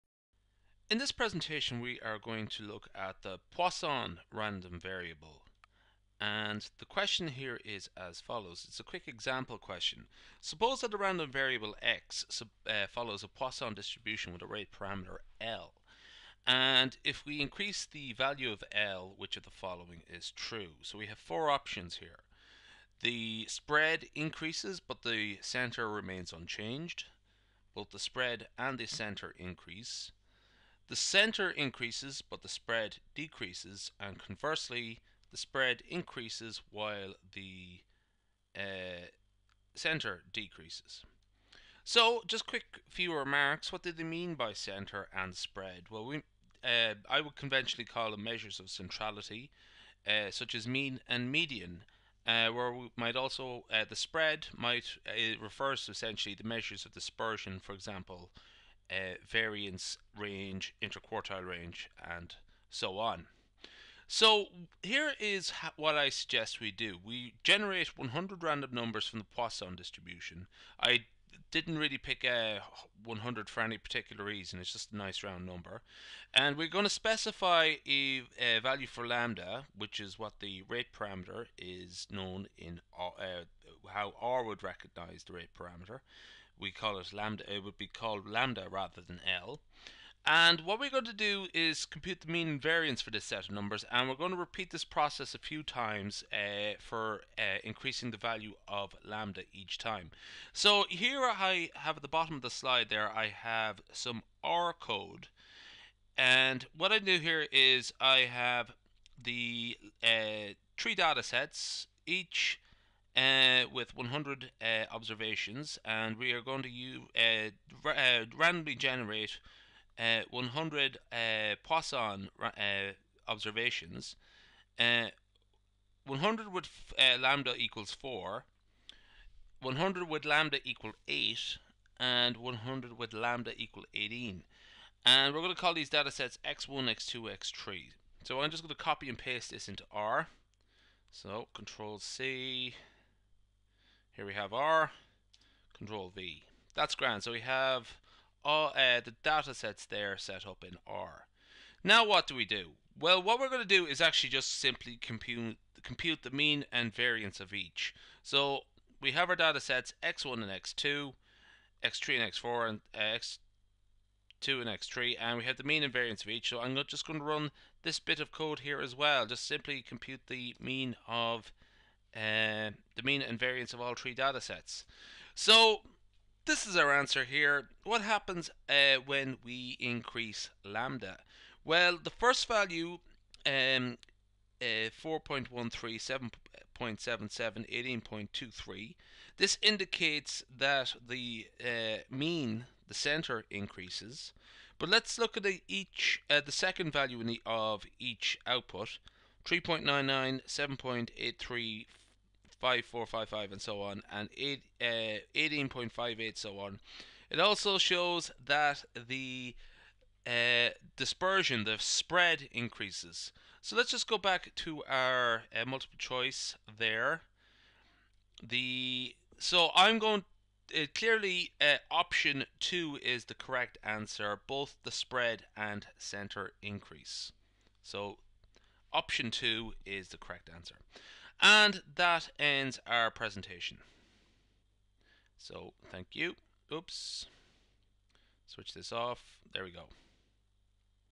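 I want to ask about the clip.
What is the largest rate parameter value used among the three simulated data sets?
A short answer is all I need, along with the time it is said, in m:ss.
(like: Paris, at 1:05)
18, at 2:13.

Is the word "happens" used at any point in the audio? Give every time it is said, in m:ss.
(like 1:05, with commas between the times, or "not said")
2:58.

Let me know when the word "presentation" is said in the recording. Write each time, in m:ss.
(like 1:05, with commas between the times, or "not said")
0:01, 3:53.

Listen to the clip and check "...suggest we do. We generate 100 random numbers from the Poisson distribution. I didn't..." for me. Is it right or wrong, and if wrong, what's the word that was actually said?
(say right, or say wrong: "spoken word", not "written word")
right.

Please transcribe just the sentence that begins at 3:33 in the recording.
So let's just go back to our uh, multiple choice there.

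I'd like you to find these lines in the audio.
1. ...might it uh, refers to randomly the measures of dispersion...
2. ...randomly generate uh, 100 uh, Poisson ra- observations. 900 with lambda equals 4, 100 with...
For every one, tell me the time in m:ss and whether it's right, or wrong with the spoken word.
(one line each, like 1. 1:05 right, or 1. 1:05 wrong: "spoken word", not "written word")
1. 0:54 wrong: "essentially", not "randomly"
2. 1:58 wrong: "100", not "900".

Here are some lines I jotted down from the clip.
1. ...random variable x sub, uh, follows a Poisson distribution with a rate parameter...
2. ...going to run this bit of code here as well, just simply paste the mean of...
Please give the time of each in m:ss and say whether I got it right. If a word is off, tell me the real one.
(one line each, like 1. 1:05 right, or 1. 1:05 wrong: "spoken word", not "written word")
1. 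0:10 right
2. 2:47 wrong: "compute", not "paste".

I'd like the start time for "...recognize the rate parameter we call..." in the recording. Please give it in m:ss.
1:24.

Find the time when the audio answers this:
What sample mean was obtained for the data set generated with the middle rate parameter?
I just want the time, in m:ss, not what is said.
3:06.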